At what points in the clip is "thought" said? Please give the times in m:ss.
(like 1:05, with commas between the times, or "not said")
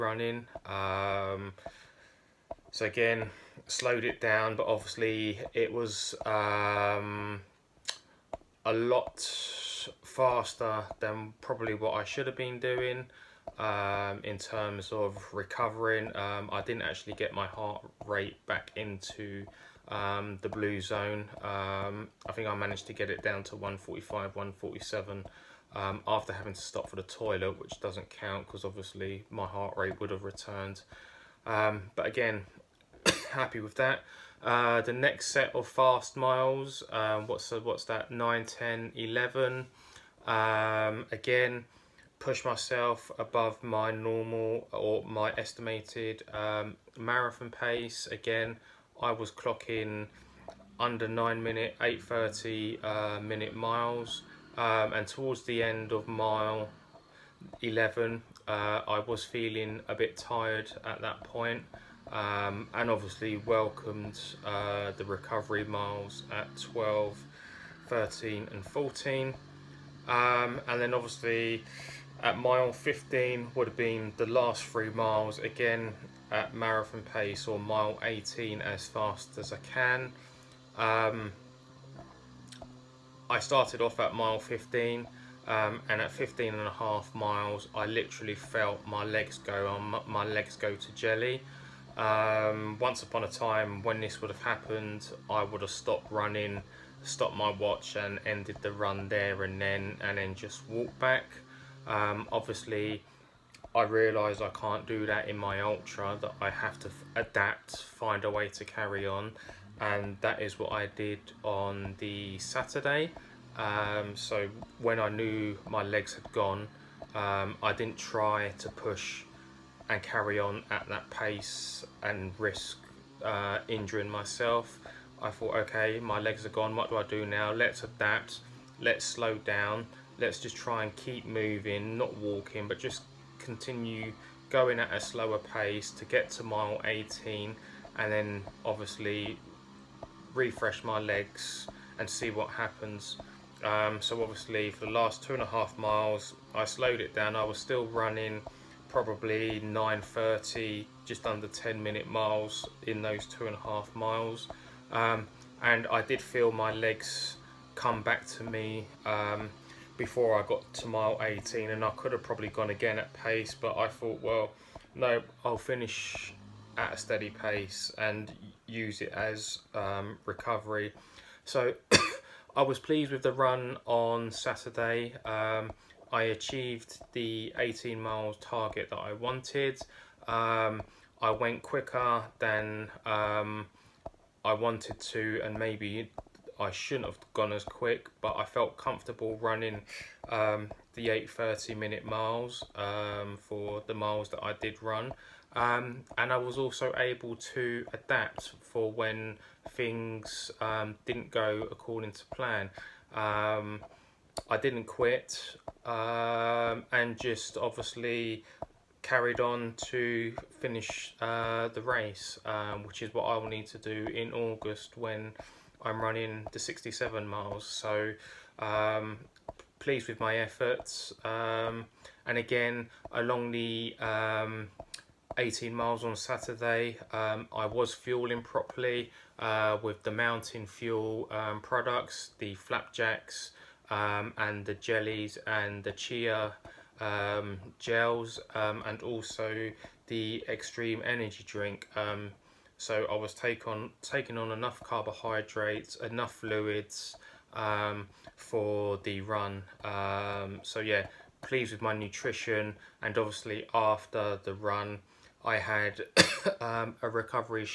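2:05, 2:43.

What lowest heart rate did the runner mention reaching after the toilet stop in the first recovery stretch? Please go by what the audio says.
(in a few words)
145.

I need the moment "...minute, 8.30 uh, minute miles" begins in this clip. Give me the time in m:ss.
0:51.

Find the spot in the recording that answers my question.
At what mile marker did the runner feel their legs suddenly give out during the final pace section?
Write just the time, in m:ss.
1:26.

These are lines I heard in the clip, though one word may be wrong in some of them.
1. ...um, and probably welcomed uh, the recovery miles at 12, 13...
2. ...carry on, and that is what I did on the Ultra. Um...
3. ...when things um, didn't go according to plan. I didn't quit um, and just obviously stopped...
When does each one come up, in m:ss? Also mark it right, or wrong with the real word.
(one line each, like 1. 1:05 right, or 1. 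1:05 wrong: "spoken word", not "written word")
1. 1:02 wrong: "obviously", not "probably"
2. 1:48 wrong: "Saturday", not "Ultra"
3. 3:18 wrong: "carried", not "stopped".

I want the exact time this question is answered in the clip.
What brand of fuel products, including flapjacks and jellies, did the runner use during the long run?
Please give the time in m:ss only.
3:50.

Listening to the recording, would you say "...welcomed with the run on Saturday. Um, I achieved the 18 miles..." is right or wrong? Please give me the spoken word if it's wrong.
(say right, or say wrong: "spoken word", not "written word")
wrong: "pleased", not "welcomed".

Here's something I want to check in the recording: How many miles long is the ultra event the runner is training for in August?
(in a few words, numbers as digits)
67.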